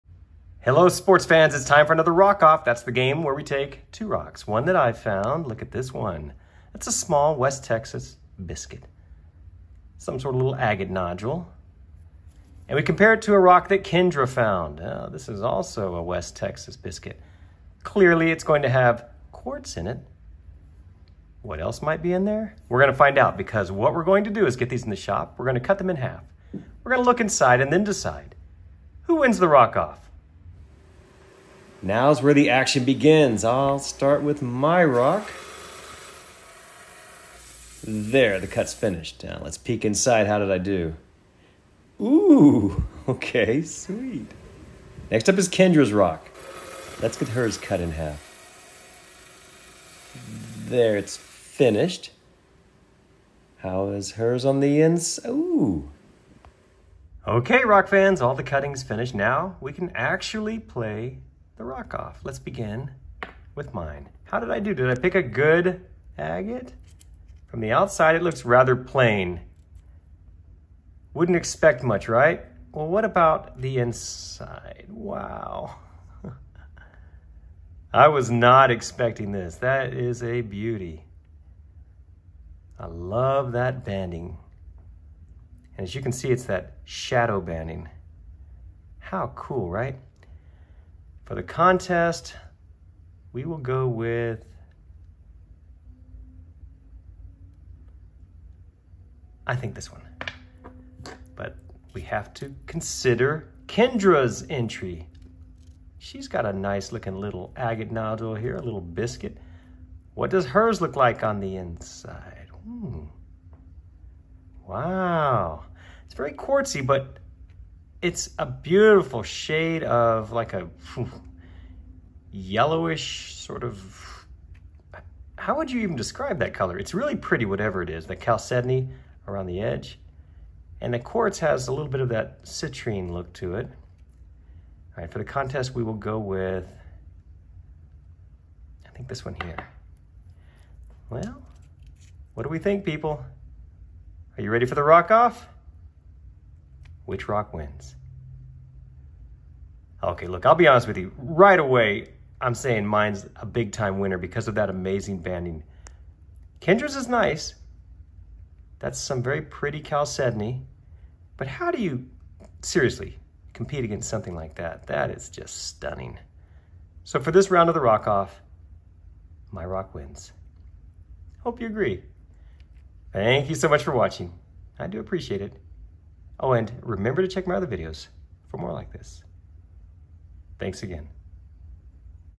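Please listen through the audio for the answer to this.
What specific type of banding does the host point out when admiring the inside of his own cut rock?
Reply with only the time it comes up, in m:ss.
1:26.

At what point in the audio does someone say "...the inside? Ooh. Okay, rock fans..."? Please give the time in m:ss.
0:54.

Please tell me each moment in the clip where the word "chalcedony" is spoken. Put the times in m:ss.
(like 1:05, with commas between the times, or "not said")
2:08, 2:39.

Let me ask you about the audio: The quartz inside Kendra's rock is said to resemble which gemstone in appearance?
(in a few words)
citrine.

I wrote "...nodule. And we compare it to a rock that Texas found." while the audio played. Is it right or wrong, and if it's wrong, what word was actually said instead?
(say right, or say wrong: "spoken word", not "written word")
wrong: "Kendra", not "Texas".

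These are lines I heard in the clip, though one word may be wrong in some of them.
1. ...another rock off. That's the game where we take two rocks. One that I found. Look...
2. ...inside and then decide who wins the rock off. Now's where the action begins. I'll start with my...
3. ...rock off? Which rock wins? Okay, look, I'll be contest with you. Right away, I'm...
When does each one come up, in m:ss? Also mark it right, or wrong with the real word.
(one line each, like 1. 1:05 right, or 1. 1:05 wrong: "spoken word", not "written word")
1. 0:01 right
2. 0:27 right
3. 2:24 wrong: "honest", not "contest".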